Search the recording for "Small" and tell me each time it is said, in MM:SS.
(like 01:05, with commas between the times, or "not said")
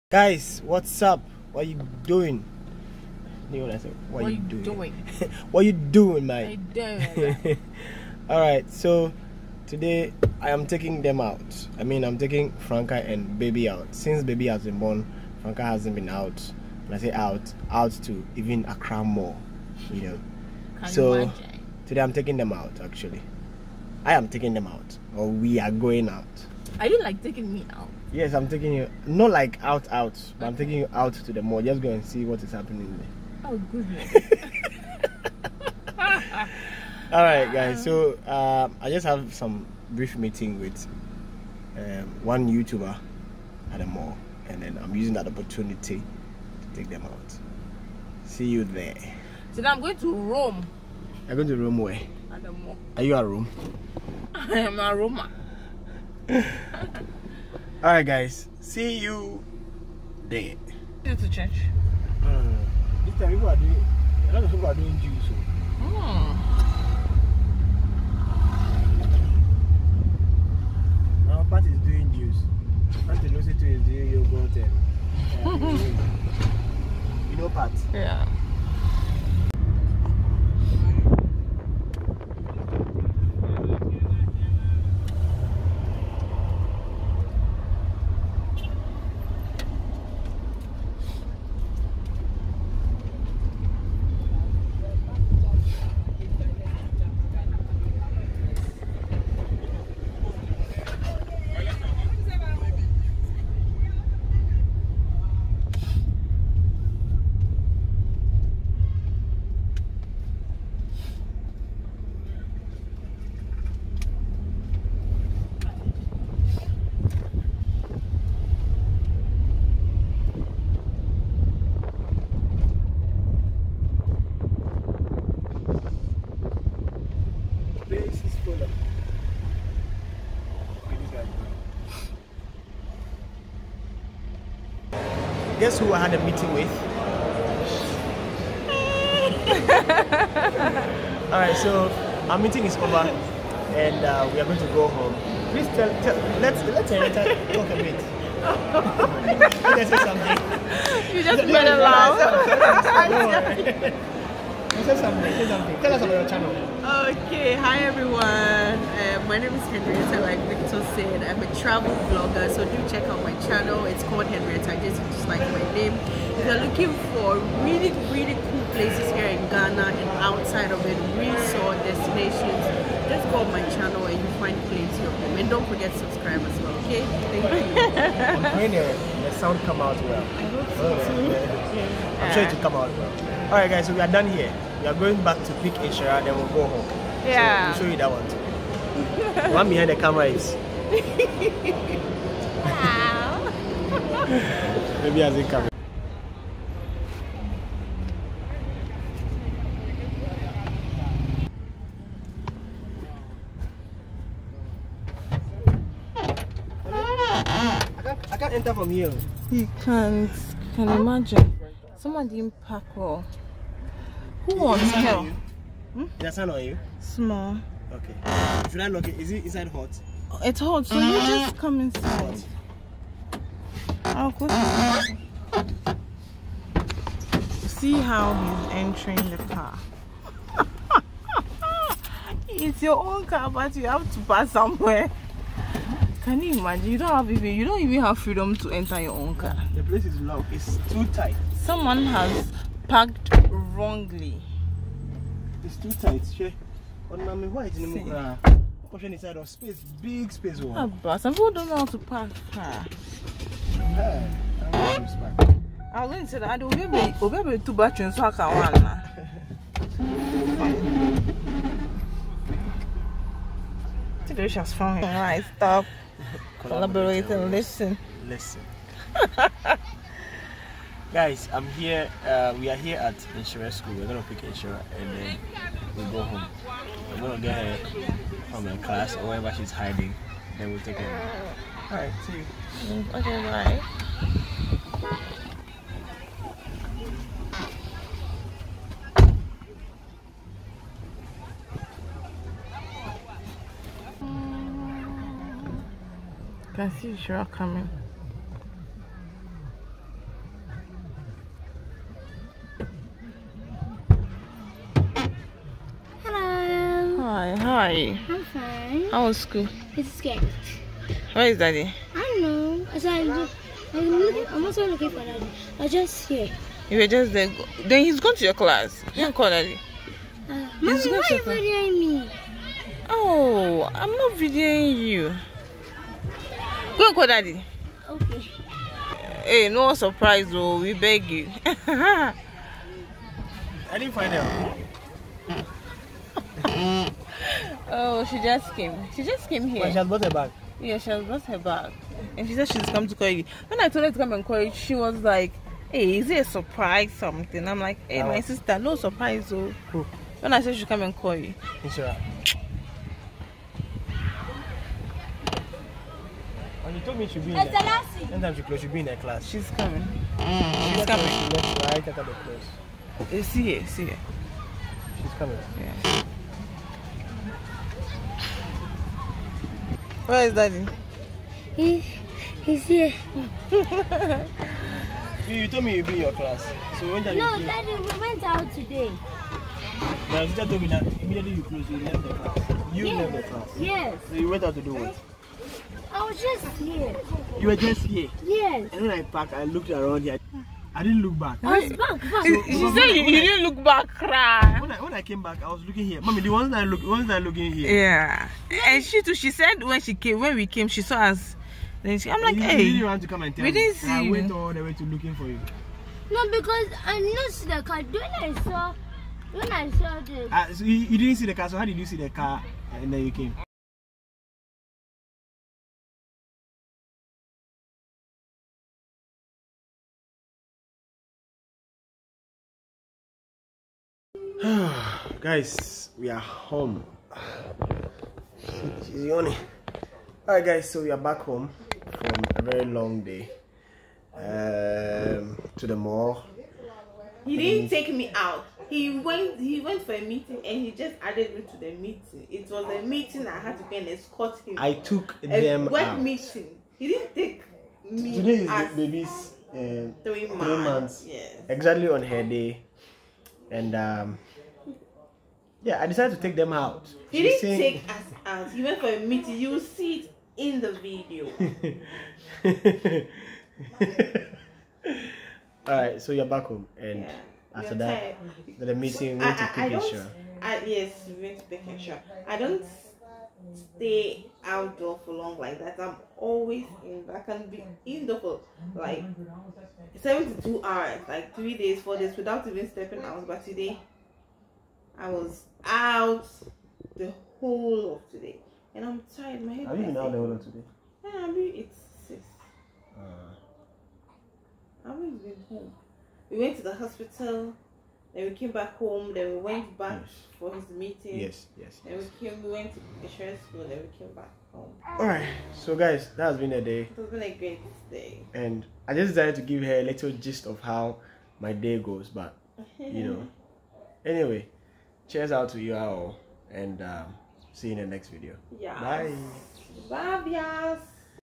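03:36.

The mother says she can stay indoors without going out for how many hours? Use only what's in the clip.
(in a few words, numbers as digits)
72 hours.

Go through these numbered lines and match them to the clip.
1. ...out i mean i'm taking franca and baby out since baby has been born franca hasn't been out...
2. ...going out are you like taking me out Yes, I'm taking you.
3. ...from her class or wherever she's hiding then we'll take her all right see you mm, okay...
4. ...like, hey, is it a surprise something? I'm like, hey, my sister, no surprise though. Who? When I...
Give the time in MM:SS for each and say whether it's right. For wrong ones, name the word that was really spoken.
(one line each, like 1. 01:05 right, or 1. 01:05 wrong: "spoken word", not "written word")
1. 00:11 right
2. 00:25 right
3. 04:38 right
4. 05:45 right.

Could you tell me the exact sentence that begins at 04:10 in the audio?
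Ah, but some people don't know how to park car.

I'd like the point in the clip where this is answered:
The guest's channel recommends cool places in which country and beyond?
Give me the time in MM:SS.
02:49.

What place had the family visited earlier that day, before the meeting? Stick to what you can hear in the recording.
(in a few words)
The hospital.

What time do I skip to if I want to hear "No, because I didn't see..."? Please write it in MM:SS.
06:46.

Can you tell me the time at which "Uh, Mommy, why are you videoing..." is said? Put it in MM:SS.
05:20.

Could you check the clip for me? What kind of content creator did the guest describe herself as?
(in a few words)
Travel blogger.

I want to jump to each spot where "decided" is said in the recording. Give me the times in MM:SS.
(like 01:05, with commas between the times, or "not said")
07:36, 08:29.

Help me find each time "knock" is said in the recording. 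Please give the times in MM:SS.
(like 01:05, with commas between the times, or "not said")
03:38.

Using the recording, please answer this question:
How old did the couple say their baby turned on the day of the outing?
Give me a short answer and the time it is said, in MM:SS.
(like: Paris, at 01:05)
3 months, at 07:30.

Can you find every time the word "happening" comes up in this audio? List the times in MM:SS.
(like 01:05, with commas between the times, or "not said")
00:32.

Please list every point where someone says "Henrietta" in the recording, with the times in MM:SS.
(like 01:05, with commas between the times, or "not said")
02:26, 02:39, 02:44.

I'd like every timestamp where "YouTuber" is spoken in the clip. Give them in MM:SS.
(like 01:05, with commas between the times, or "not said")
00:42.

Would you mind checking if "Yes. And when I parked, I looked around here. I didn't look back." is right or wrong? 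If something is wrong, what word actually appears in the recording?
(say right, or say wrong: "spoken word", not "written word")
right.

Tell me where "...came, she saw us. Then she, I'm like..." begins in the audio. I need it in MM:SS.
06:40.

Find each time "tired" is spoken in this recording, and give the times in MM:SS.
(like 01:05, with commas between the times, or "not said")
07:48, 08:09.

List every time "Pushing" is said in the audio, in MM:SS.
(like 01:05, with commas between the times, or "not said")
04:08.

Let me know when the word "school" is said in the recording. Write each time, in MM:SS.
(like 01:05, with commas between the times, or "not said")
04:33, 05:09, 08:23.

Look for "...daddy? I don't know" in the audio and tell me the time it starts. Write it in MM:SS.
05:11.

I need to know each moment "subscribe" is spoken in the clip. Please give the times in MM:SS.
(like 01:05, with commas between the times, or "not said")
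02:55.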